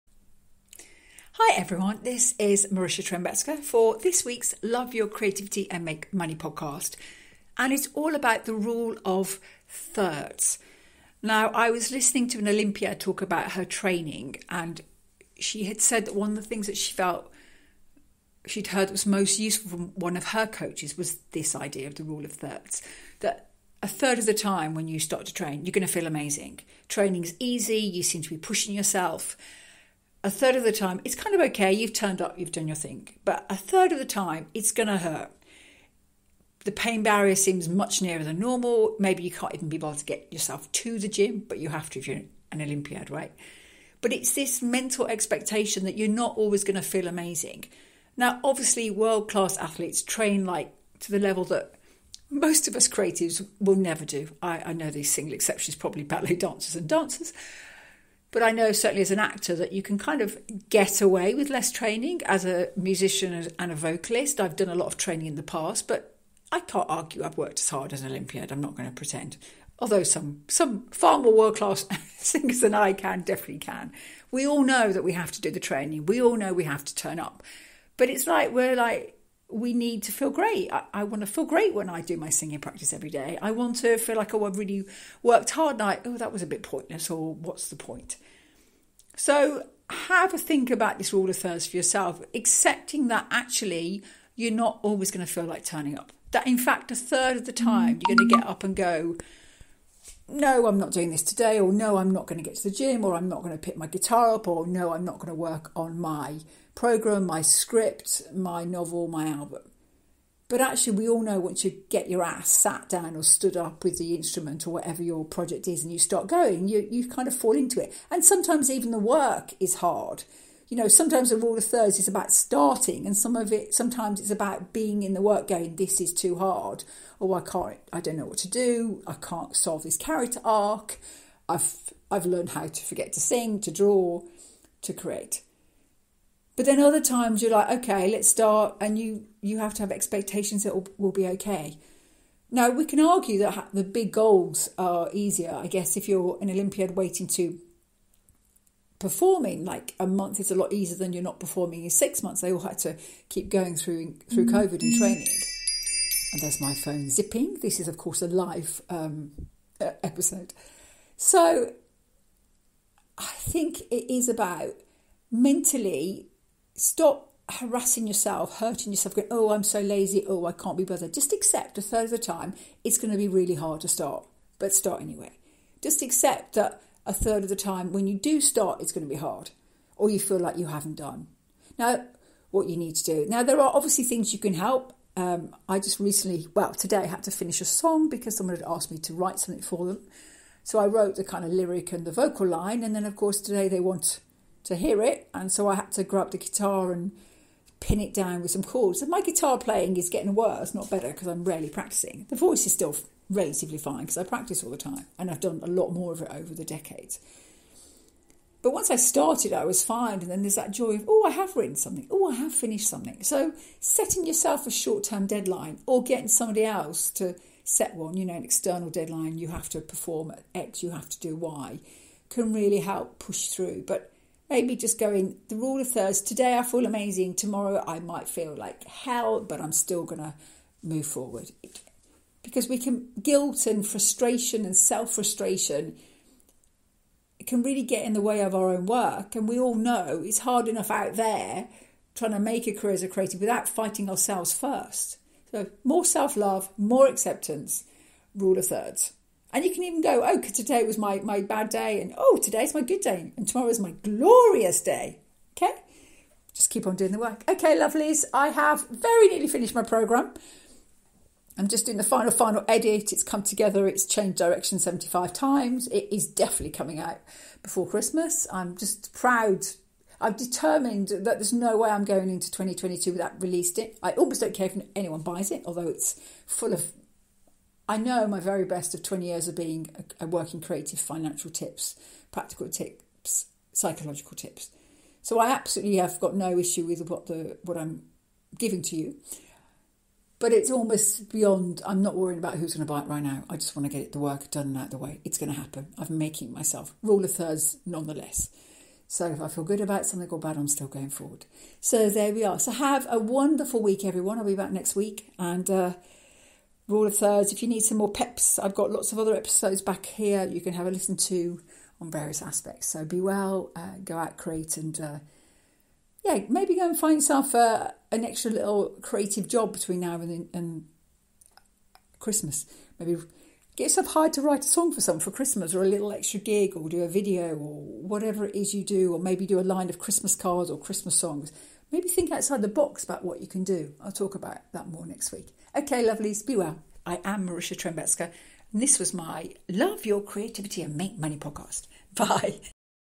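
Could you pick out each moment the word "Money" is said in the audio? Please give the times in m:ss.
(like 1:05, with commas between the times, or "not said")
0:06, 5:41.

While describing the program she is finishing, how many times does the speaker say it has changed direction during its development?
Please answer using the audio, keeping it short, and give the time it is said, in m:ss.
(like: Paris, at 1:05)
75, at 4:24.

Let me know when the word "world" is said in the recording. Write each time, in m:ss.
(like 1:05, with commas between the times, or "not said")
0:48, 1:11.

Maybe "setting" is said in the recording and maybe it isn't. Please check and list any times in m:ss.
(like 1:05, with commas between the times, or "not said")
3:33.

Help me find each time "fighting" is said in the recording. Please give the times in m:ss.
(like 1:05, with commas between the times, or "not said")
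4:03.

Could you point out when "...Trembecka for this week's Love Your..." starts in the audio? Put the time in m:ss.
0:03.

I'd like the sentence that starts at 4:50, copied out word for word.
But it's almost beyond, I'm not worrying about who's going to buy it right now.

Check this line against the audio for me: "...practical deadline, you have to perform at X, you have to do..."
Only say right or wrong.
wrong.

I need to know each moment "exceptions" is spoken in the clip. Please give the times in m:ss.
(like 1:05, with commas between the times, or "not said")
0:55.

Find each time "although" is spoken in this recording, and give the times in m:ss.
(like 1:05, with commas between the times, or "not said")
1:09, 4:35.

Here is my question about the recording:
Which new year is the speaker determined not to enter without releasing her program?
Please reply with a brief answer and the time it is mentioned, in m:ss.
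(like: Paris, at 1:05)
2022, at 4:32.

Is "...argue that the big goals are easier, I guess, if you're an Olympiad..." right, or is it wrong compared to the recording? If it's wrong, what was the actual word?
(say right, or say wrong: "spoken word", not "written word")
right.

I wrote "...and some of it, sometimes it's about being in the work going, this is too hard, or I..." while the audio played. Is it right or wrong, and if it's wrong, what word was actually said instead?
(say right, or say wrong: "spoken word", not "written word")
right.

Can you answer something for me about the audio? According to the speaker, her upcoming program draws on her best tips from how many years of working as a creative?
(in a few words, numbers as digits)
20 years.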